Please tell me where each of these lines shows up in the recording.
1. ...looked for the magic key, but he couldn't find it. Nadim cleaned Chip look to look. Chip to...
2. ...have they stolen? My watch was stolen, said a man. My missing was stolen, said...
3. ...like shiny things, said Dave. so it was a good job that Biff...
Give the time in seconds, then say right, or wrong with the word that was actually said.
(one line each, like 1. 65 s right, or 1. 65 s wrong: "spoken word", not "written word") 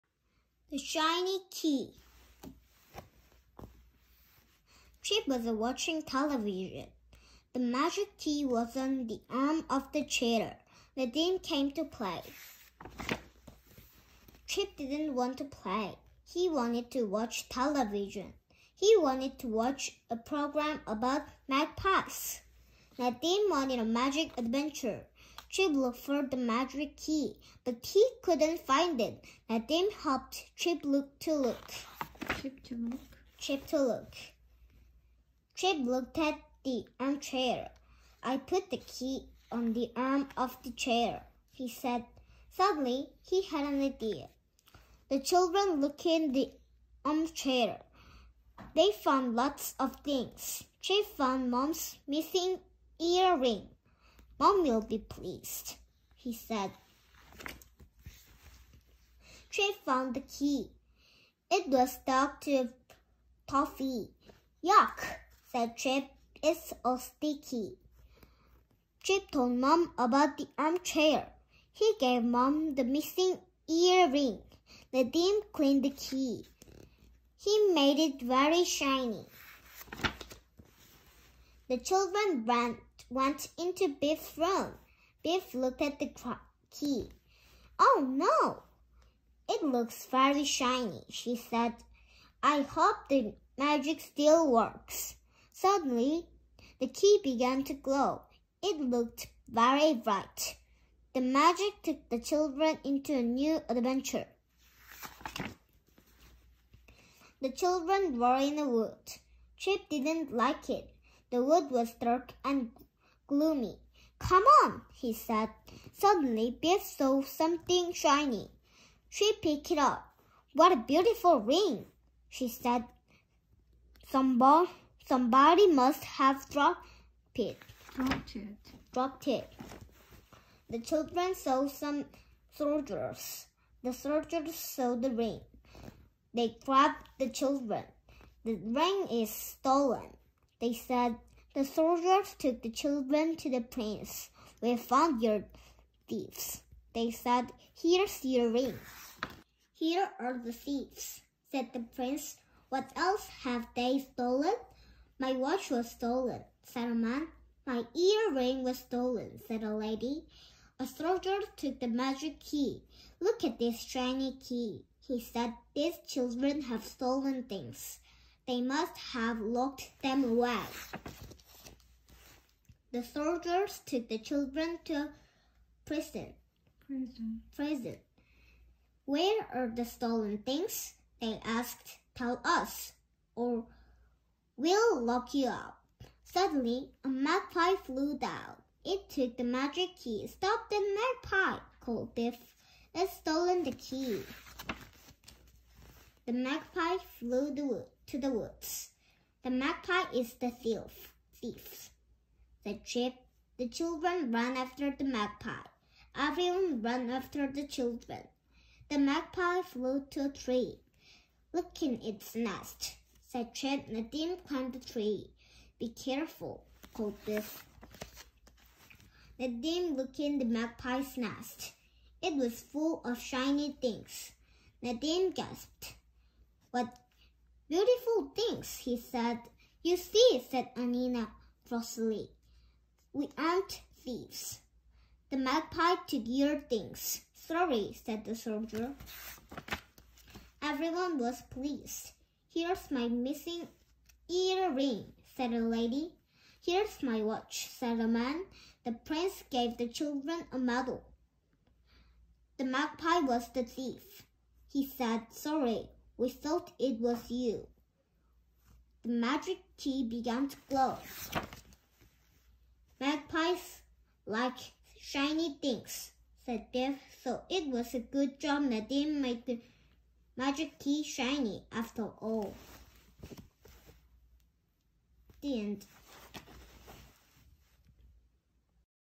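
1. 25 s wrong: "helped", not "cleaned"
2. 153 s wrong: "earring", not "missing"
3. 264 s wrong: "Nadim", not "Biff".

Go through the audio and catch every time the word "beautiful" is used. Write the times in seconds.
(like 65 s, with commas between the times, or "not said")
120 s, 227 s.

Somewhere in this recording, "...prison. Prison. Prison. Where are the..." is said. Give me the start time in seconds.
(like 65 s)
175 s.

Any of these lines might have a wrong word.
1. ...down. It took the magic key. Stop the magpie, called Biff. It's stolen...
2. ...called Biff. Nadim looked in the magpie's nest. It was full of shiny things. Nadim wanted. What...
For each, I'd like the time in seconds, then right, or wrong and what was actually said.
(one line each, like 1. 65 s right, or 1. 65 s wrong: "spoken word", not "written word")
1. 188 s right
2. 216 s wrong: "gasped", not "wanted".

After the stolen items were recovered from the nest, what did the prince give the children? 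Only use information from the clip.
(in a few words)
A medal.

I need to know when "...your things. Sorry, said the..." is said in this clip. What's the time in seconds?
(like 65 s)
236 s.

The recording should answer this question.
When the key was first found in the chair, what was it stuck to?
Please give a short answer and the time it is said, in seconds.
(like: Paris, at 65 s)
Toffee, at 63 s.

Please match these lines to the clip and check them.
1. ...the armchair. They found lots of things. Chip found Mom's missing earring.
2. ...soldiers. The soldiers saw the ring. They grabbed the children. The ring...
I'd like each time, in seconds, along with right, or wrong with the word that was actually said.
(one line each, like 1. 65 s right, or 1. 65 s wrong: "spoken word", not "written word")
1. 46 s right
2. 132 s right.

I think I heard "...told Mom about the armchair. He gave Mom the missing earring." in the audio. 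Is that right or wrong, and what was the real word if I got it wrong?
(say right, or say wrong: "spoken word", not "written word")
right.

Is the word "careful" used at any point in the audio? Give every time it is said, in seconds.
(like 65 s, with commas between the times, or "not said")
215 s.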